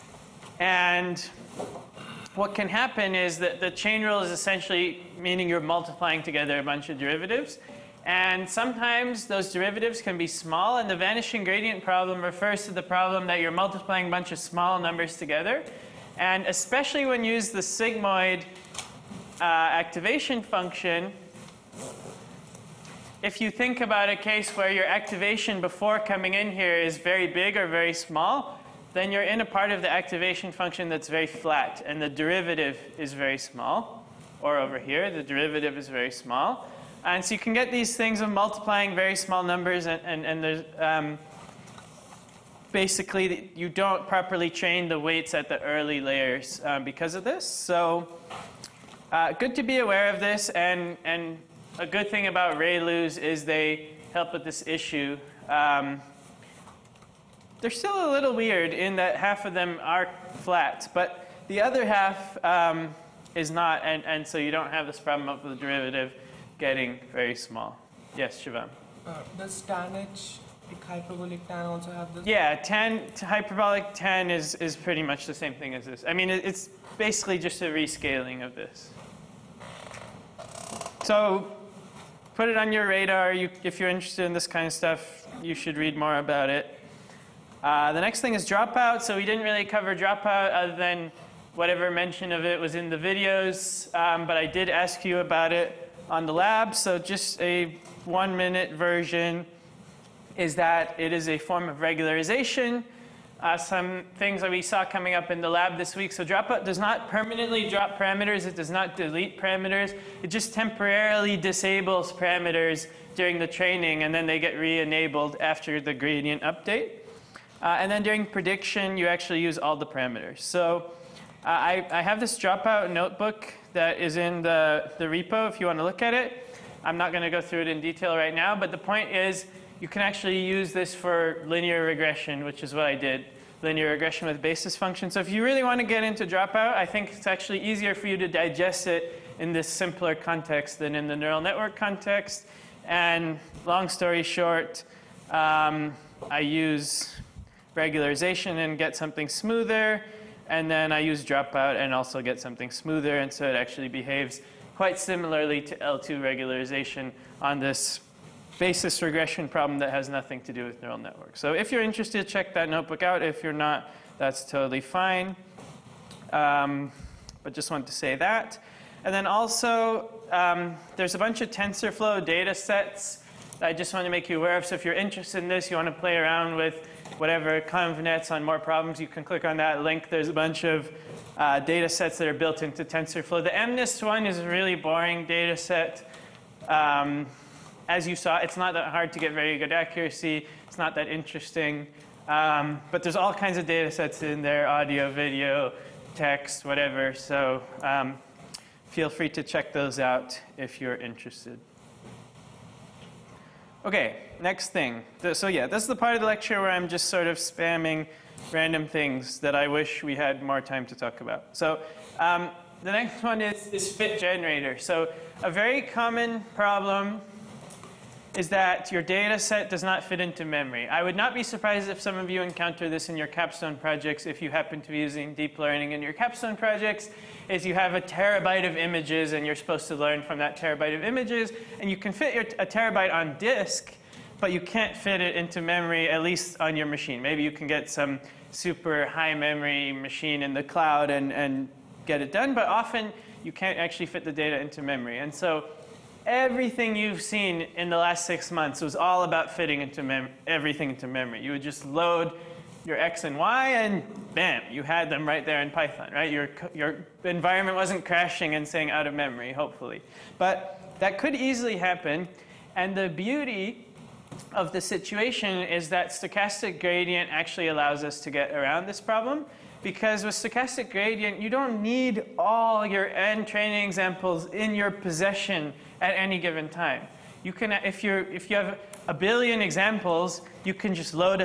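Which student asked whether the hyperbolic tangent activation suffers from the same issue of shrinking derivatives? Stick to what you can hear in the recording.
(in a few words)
Shivam.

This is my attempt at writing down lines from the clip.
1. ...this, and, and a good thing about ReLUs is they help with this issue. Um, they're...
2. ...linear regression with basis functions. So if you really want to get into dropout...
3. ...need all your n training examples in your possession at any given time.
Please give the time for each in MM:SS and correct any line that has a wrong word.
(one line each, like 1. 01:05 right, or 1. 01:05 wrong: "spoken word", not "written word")
1. 00:50 right
2. 02:13 right
3. 04:31 right.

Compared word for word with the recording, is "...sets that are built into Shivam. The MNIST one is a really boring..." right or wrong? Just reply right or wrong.
wrong.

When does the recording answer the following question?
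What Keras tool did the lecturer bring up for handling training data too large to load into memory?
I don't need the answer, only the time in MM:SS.
03:33.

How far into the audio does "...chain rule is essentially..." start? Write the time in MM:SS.
00:03.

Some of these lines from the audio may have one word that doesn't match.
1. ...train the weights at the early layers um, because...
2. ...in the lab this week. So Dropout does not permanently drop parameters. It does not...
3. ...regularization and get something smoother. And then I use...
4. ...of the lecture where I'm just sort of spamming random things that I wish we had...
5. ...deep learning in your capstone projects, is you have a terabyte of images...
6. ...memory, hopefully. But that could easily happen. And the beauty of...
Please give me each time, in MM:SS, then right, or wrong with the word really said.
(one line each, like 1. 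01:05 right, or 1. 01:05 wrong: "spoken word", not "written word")
1. 00:44 right
2. 01:45 right
3. 02:27 right
4. 03:26 right
5. 03:45 right
6. 04:19 right.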